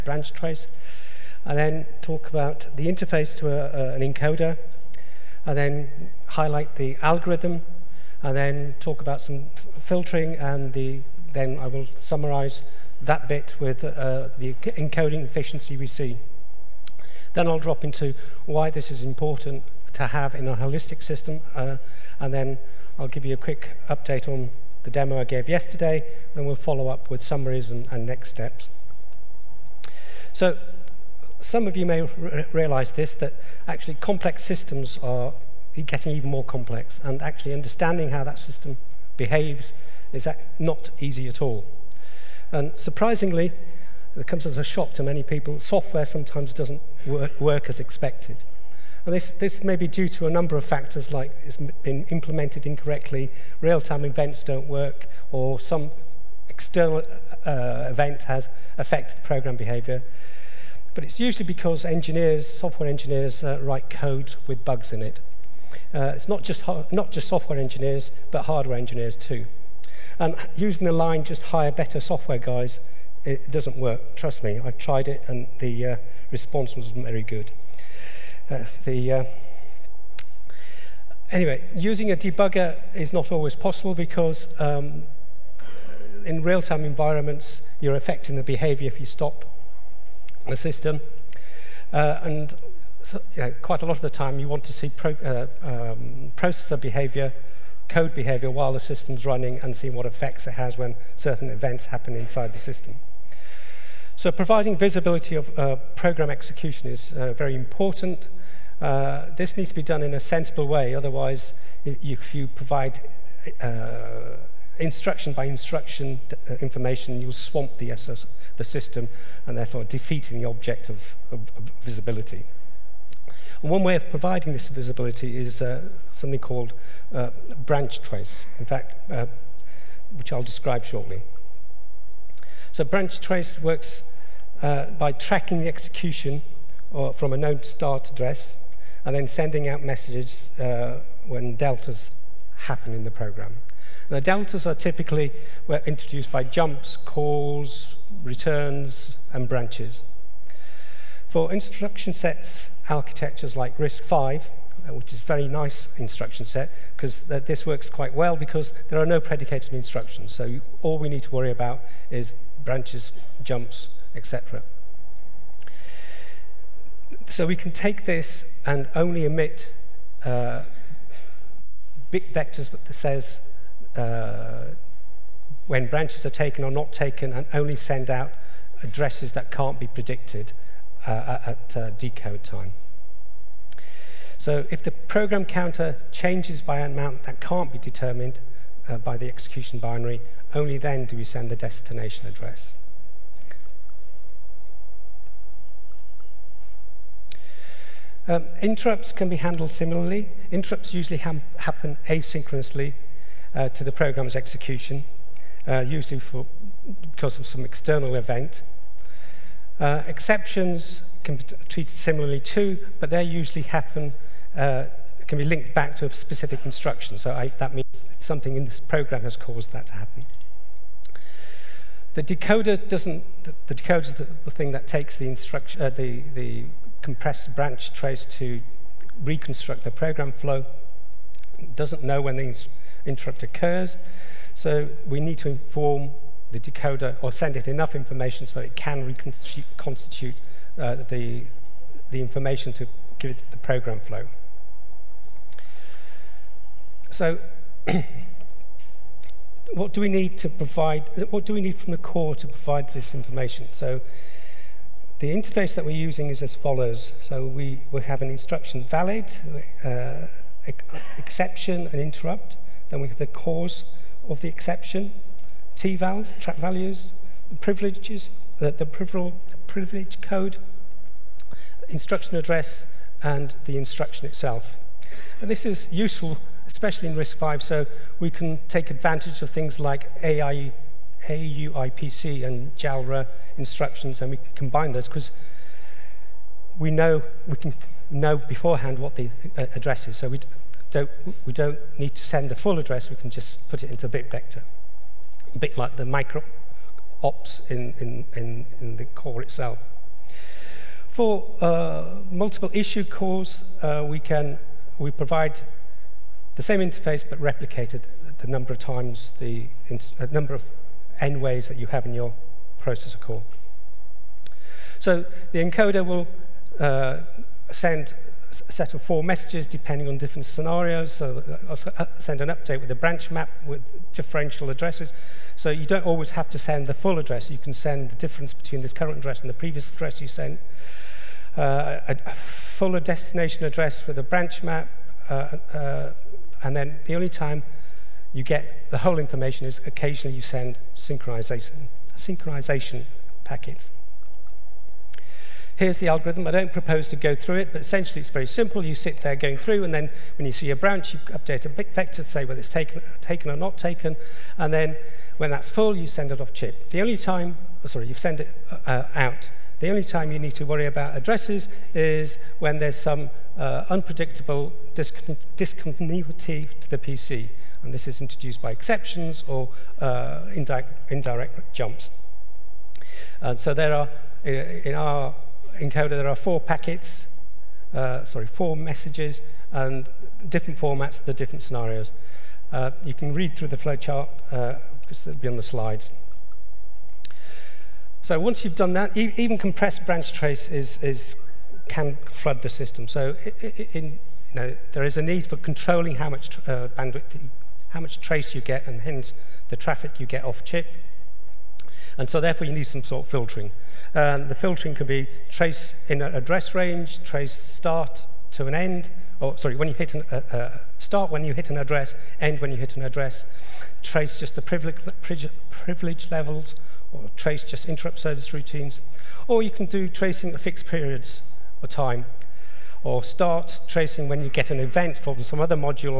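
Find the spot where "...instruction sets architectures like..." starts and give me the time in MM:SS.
02:31.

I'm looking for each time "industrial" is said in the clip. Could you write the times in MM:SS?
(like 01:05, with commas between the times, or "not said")
not said.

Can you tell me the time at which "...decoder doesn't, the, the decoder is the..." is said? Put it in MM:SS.
03:42.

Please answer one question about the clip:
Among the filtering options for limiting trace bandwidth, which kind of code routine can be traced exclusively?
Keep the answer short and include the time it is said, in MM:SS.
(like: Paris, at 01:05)
Interrupt service routines, at 06:57.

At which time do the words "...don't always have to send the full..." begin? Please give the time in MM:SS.
05:25.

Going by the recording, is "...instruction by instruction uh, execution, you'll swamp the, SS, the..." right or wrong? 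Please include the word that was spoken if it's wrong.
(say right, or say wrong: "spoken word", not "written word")
wrong: "information", not "execution".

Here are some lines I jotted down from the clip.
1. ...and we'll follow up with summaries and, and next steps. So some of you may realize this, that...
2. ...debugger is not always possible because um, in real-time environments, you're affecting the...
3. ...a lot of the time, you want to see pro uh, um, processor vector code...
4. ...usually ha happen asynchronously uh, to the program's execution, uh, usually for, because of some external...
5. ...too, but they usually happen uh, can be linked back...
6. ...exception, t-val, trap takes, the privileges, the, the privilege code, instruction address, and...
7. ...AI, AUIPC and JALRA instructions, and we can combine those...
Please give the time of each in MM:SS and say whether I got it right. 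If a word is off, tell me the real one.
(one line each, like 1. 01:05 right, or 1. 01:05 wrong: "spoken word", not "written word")
1. 00:26 right
2. 01:22 right
3. 01:33 wrong: "behavior", not "vector"
4. 03:20 right
5. 03:32 right
6. 04:24 wrong: "values", not "takes"
7. 04:40 right.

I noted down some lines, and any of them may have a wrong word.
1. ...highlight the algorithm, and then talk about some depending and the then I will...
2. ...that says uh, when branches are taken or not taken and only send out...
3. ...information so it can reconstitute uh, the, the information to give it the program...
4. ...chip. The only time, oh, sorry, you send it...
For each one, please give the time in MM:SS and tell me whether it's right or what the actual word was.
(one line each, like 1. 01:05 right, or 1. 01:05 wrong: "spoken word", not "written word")
1. 00:06 wrong: "filtering", not "depending"
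2. 02:52 right
3. 03:57 right
4. 05:56 right.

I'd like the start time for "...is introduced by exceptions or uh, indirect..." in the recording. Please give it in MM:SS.
06:08.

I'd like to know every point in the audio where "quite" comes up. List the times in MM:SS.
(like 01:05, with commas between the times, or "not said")
01:33, 02:37.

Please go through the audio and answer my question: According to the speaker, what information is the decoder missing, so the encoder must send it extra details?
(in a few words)
When the interrupt occurs.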